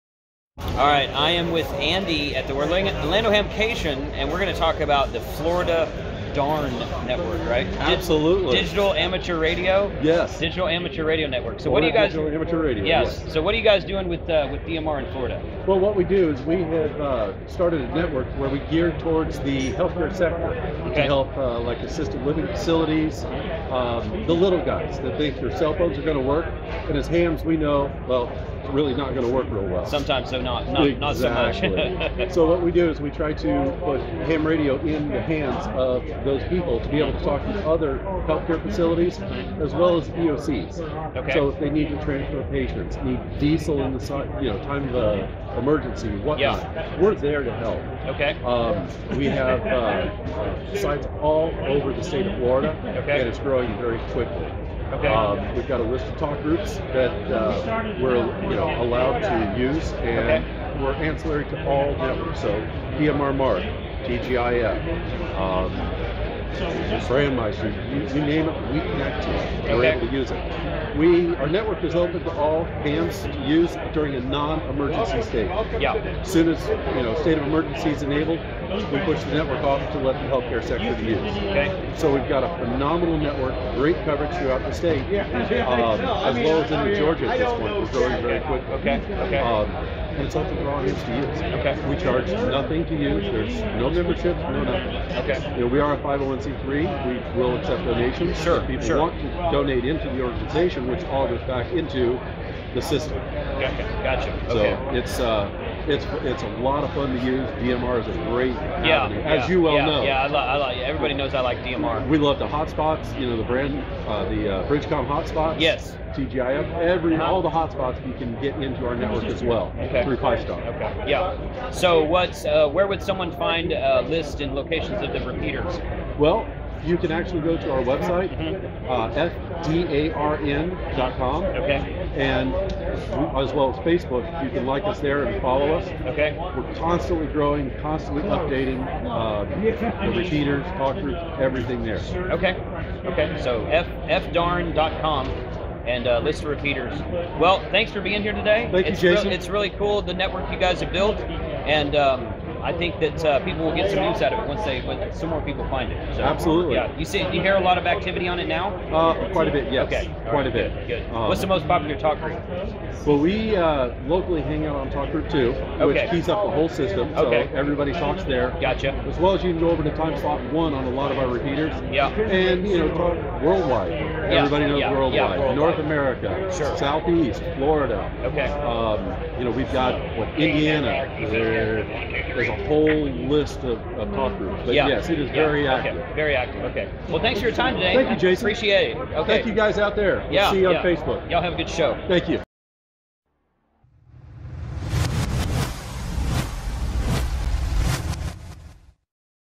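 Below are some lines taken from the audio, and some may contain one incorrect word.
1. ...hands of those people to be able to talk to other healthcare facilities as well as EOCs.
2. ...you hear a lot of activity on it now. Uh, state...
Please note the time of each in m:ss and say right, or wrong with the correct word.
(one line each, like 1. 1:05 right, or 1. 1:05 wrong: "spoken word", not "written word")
1. 0:35 right
2. 2:37 wrong: "quite", not "state".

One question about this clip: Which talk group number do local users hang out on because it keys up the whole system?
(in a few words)
2.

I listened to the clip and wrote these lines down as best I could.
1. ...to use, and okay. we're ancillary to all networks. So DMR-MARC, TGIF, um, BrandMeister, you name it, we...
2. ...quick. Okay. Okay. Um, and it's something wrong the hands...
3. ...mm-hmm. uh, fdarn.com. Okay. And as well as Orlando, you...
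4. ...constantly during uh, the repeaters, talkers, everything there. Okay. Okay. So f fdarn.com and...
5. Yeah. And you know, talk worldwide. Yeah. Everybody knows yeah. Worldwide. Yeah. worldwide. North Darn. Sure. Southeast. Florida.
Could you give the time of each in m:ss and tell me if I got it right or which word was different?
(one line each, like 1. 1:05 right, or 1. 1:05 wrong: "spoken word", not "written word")
1. 0:59 right
2. 1:28 right
3. 2:08 wrong: "Facebook", not "Orlando"
4. 2:17 wrong: "updating", not "during"
5. 2:51 wrong: "America", not "Darn".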